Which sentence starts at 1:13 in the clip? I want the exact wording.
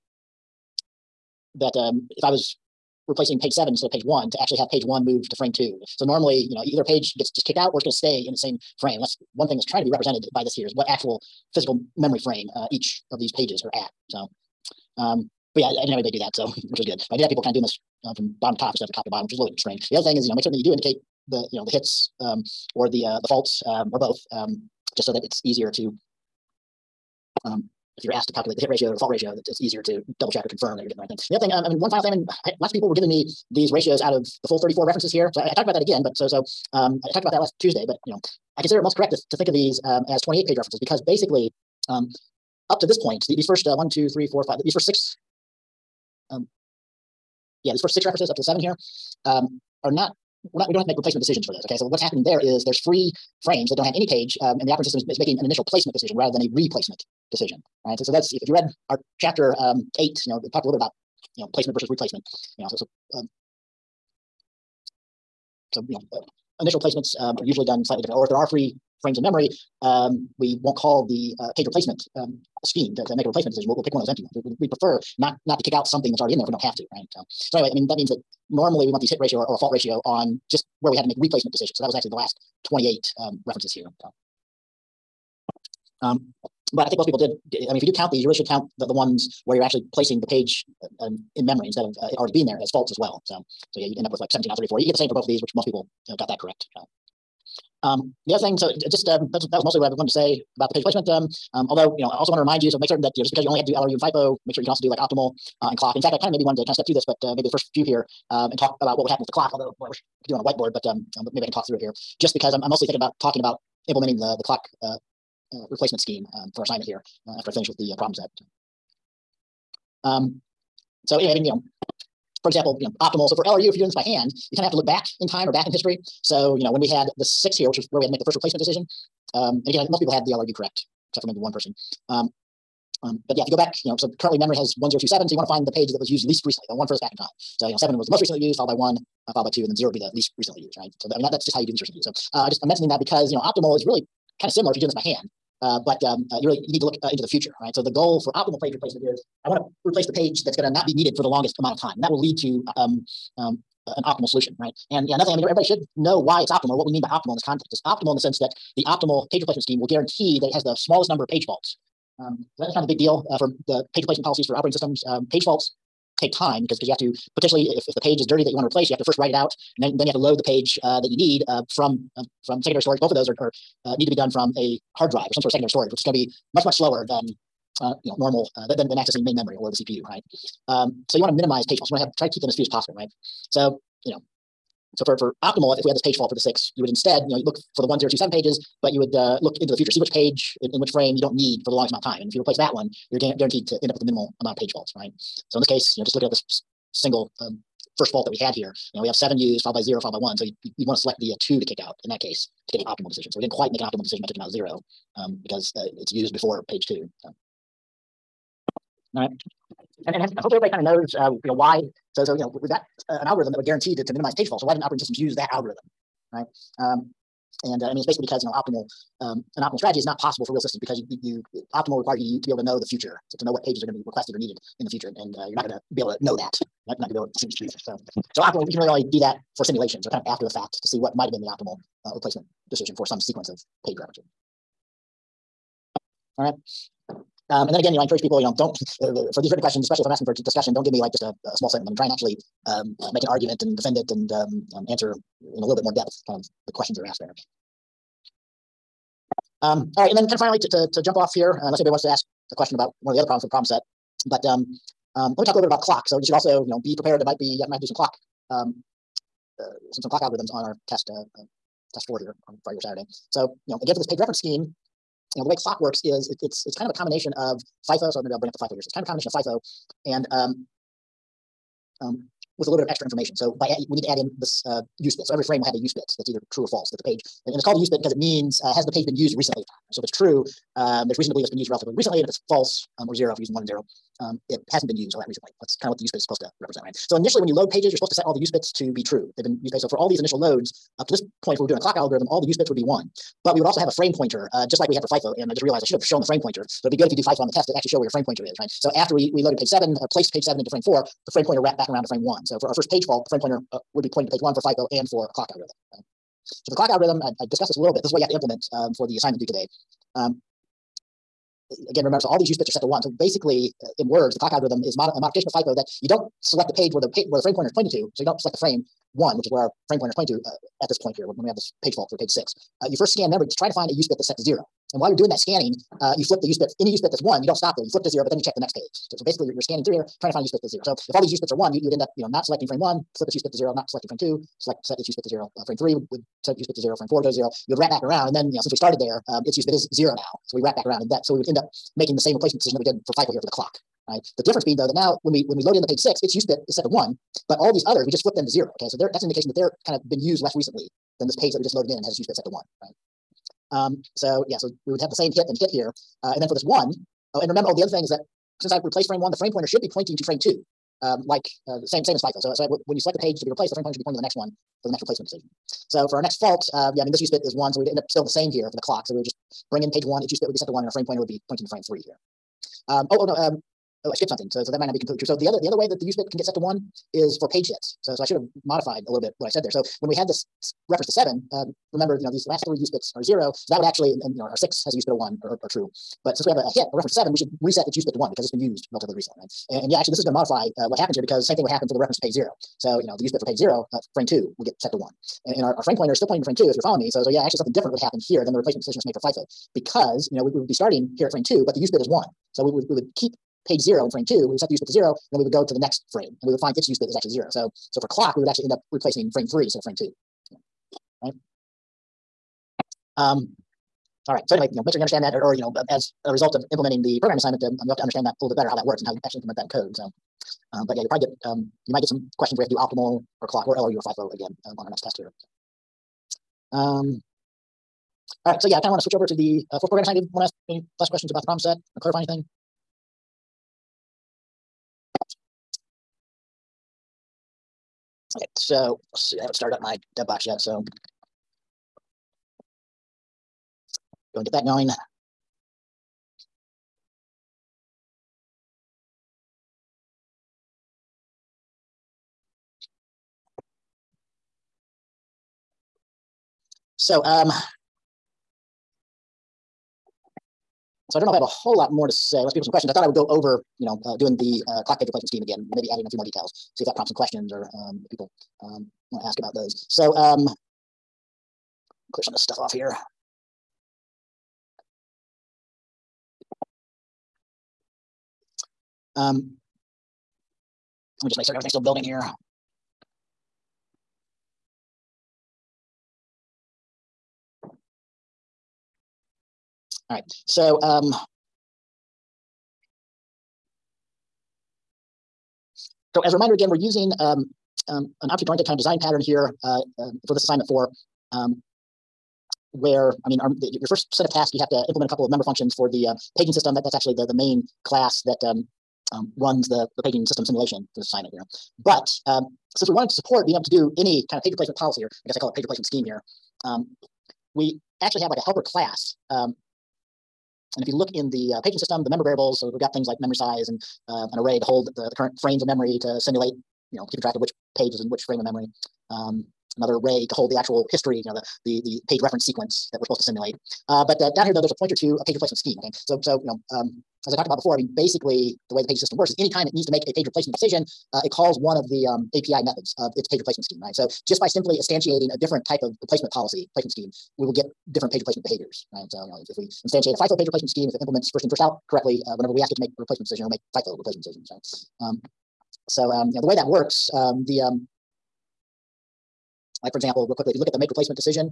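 We'll, we'll, pick one of those empty ones.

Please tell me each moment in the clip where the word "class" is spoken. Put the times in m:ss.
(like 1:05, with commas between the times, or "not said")
8:27, 8:38.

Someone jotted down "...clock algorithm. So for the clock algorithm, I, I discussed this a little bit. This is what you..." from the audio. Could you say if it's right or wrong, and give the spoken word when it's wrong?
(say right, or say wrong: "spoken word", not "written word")
right.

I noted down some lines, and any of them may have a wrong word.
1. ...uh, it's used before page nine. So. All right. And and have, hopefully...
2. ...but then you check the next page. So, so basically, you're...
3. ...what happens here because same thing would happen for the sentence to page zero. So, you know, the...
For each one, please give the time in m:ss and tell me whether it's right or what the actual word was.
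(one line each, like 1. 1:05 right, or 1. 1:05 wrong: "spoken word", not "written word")
1. 3:25 wrong: "two", not "nine"
2. 5:28 right
3. 6:30 wrong: "reference", not "sentence".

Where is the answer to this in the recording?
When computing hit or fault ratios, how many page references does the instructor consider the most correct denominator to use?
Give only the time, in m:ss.
0:40.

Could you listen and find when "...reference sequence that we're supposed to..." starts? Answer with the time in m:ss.
8:52.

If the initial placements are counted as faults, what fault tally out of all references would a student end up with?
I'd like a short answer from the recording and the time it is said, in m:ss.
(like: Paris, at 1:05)
17 out of 34, at 1:34.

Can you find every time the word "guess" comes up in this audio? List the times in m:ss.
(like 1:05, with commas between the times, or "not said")
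8:35.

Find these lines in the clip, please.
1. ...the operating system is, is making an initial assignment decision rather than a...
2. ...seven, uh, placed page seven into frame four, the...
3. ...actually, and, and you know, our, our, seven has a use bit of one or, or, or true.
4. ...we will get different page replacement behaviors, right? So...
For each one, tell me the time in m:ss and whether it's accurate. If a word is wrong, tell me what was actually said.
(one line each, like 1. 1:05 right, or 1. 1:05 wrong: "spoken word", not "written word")
1. 0:54 wrong: "placement", not "assignment"
2. 4:59 right
3. 6:23 wrong: "six", not "seven"
4. 9:07 right.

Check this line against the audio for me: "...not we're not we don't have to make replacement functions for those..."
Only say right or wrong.
wrong.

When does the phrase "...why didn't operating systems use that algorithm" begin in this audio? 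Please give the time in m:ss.
3:34.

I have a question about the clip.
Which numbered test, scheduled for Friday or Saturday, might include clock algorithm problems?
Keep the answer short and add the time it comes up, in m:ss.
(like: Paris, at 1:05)
Test 4, at 4:21.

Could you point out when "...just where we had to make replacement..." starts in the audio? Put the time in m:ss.
1:20.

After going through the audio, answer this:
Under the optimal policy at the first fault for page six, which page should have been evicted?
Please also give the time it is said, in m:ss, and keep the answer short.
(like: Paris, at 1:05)
Page 2, at 3:20.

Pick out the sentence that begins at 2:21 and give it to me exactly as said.
So, th- I mean, that, that's just how you do least recently used.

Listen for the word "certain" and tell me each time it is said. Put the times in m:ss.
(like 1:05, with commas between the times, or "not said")
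0:20, 1:42, 8:01.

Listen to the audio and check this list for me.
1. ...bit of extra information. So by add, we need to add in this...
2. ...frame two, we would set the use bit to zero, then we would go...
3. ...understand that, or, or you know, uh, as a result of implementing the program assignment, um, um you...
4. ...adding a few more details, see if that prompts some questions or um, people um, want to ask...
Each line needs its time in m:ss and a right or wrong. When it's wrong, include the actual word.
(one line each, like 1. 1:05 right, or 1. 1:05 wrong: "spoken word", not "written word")
1. 4:32 right
2. 6:44 right
3. 6:55 right
4. 7:45 right.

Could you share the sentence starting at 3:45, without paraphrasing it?
And, uh, you're not going to be able to know that.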